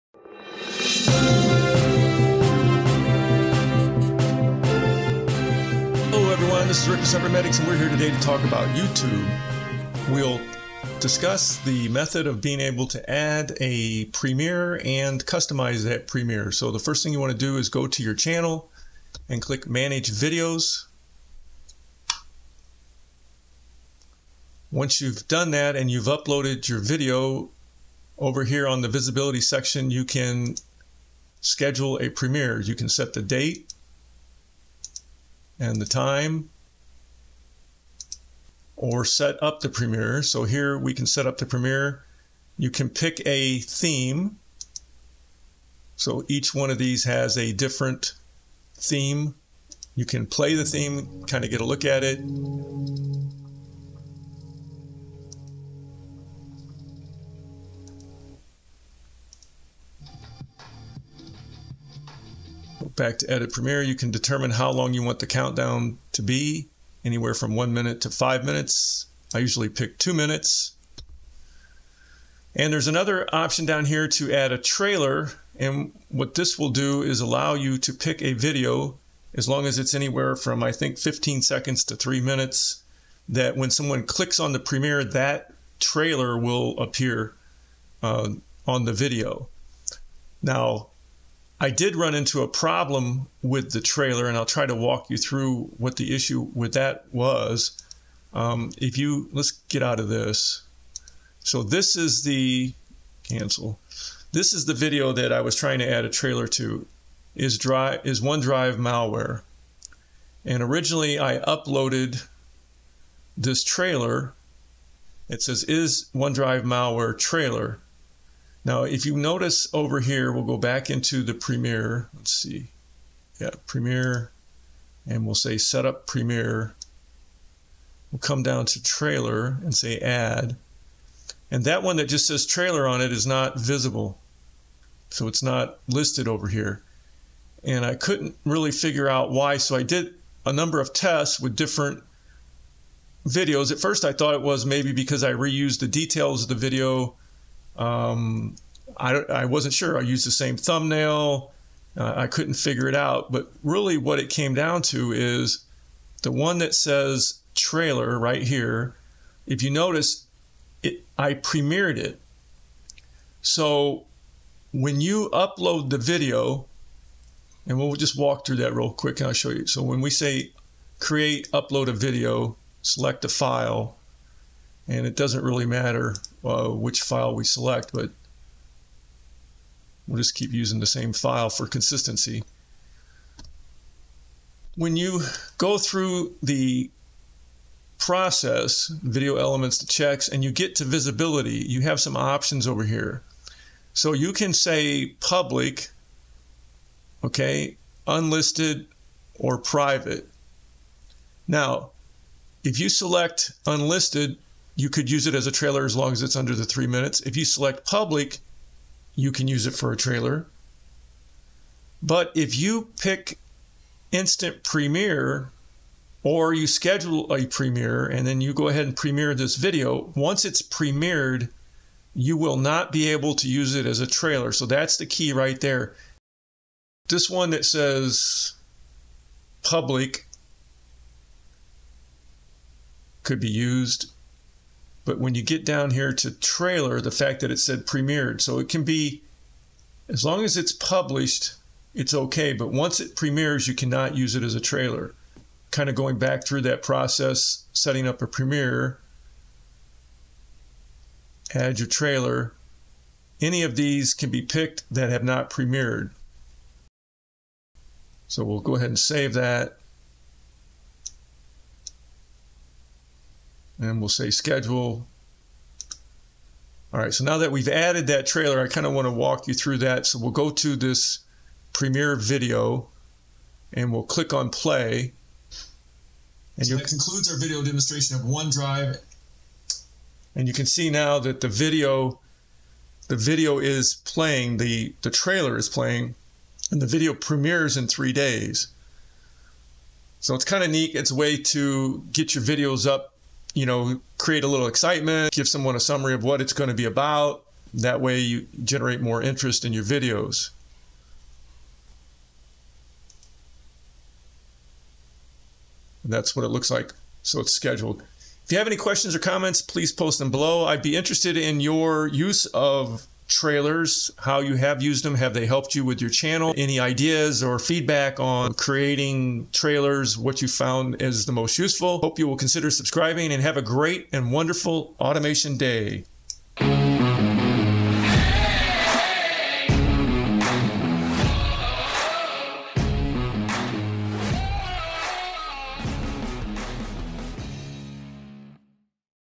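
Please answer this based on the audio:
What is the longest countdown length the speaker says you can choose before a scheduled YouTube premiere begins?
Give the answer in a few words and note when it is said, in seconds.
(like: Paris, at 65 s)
5 minutes, at 68 s.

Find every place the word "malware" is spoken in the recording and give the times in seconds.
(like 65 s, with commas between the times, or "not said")
108 s, 116 s.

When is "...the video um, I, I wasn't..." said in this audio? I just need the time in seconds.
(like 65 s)
146 s.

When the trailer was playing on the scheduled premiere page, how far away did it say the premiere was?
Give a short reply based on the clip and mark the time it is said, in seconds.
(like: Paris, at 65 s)
3 days, at 287 s.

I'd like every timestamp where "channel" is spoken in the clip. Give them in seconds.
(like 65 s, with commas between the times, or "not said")
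18 s, 316 s.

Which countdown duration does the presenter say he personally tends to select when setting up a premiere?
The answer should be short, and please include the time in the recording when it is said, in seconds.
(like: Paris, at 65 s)
2 minutes, at 69 s.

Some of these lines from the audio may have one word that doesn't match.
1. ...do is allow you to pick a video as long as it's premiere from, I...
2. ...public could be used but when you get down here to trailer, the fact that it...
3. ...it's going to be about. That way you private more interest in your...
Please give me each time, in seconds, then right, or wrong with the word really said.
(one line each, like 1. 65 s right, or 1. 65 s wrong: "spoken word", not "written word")
1. 76 s wrong: "anywhere", not "premiere"
2. 229 s right
3. 296 s wrong: "generate", not "private".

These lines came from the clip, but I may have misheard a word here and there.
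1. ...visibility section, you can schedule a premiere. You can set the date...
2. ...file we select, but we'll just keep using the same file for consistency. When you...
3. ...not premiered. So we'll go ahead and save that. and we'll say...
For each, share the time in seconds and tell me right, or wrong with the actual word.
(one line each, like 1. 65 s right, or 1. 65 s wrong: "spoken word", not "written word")
1. 28 s right
2. 177 s right
3. 255 s right.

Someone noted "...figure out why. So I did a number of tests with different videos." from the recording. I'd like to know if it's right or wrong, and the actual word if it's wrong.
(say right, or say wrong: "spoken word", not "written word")
right.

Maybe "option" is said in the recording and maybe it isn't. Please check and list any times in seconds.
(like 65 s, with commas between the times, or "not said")
73 s, 192 s.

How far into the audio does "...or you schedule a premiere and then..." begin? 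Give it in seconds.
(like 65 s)
216 s.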